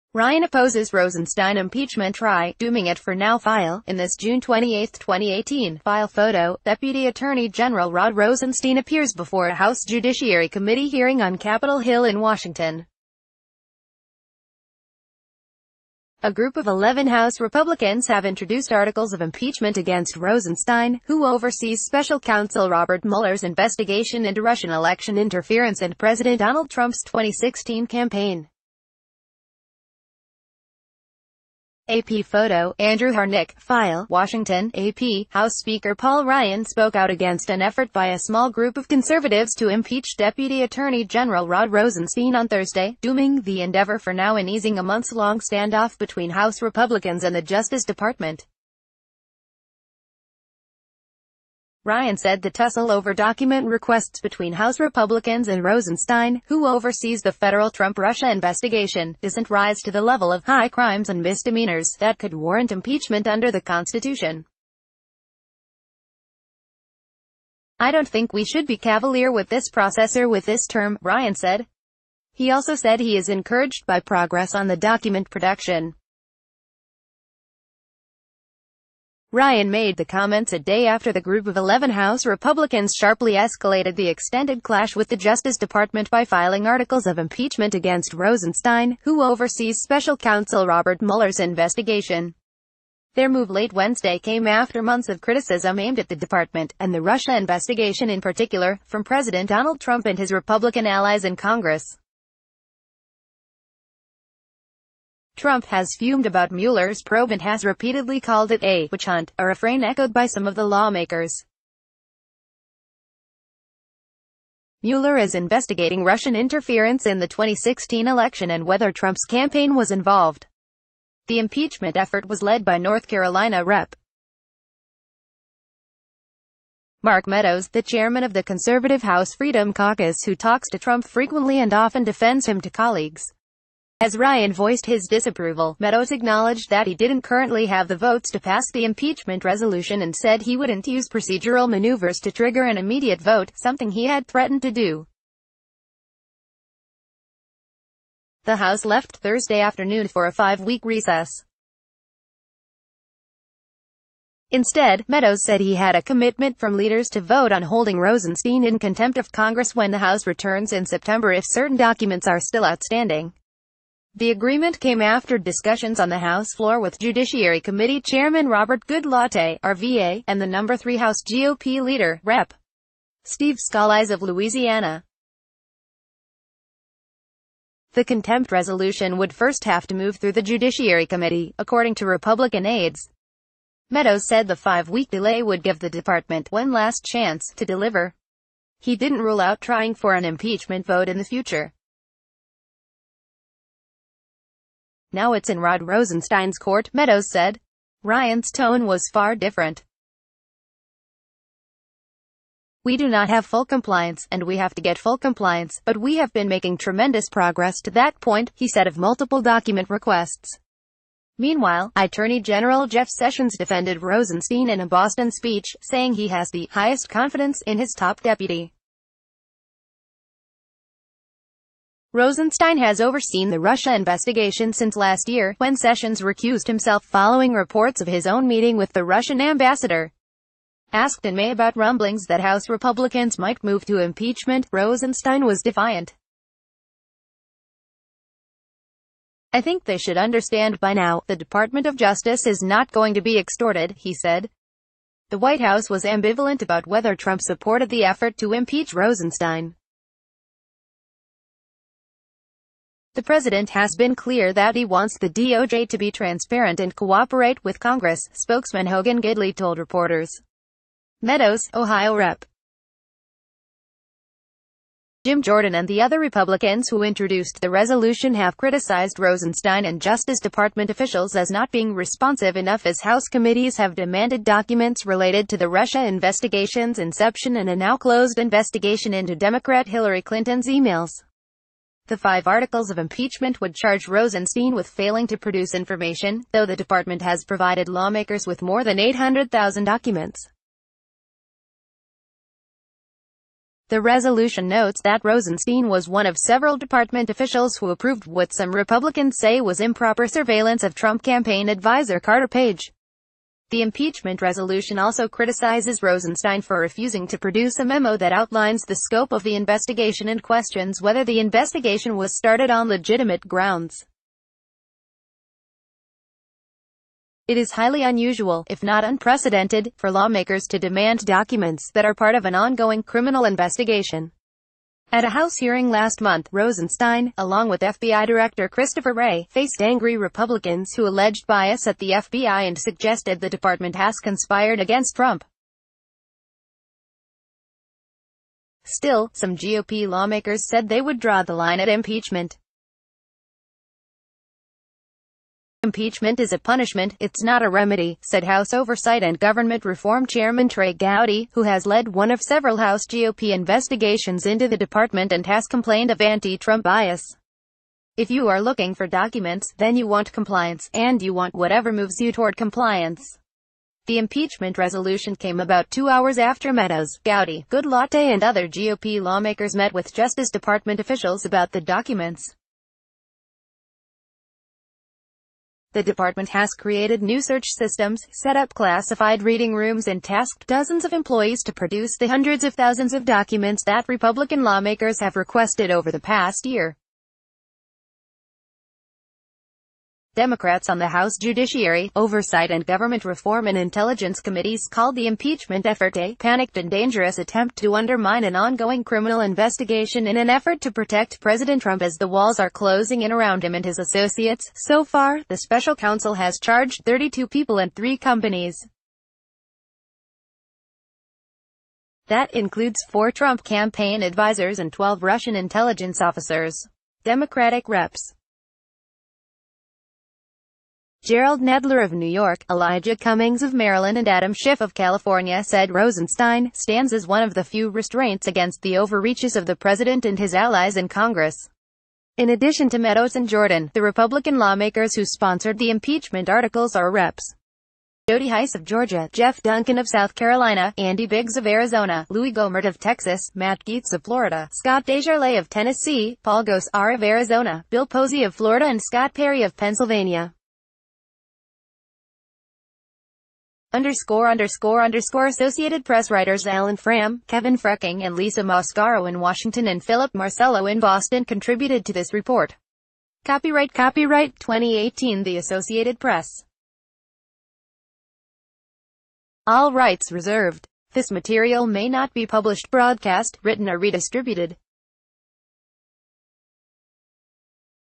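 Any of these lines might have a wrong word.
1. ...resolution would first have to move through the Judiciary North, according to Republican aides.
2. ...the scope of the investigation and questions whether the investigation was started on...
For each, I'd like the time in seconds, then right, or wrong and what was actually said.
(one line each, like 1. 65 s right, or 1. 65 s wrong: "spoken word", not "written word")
1. 178 s wrong: "Committee", not "North"
2. 308 s right.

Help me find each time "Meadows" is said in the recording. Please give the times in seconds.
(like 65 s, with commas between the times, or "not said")
127 s, 135 s, 155 s, 183 s, 196 s, 261 s, 366 s, 432 s.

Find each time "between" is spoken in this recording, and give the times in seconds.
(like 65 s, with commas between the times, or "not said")
45 s, 54 s.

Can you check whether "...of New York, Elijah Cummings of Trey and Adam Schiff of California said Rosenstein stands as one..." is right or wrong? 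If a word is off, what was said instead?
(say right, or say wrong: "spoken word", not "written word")
wrong: "Maryland", not "Trey".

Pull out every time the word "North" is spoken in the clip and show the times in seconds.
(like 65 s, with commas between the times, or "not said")
122 s.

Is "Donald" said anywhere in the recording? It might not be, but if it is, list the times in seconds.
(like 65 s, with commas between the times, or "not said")
26 s, 99 s.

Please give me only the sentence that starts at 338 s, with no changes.
Still, some GOP lawmakers said they would draw the line at impeachment.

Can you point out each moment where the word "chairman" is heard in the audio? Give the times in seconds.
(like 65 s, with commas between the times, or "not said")
127 s, 168 s, 350 s.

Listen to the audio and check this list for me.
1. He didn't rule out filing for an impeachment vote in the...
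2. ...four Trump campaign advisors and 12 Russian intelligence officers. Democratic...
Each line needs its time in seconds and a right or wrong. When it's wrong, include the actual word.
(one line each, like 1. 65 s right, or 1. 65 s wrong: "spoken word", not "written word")
1. 188 s wrong: "trying", not "filing"
2. 413 s right.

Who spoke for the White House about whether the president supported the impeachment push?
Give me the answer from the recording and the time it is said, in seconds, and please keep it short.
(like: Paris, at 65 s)
Hogan Gidley, at 258 s.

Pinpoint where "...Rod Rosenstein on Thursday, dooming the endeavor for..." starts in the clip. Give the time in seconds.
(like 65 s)
41 s.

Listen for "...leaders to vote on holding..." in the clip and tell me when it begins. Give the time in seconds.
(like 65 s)
156 s.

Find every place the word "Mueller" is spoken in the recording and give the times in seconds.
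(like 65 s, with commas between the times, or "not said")
23 s, 91 s, 106 s, 114 s.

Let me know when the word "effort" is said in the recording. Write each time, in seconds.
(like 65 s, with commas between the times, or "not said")
37 s, 121 s, 248 s, 395 s, 400 s.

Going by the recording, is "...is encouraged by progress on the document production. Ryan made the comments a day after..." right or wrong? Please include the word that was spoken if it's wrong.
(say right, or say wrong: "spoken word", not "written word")
right.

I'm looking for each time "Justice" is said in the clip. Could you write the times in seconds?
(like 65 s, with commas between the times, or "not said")
47 s, 85 s, 241 s, 270 s, 370 s.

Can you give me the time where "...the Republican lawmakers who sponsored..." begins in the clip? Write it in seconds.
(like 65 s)
433 s.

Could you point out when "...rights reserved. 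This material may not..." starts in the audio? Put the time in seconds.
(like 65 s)
469 s.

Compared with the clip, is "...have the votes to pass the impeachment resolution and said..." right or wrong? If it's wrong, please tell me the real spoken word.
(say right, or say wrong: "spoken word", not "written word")
right.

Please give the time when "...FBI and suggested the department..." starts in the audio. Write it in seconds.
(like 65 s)
332 s.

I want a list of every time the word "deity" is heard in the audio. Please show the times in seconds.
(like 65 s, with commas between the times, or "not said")
not said.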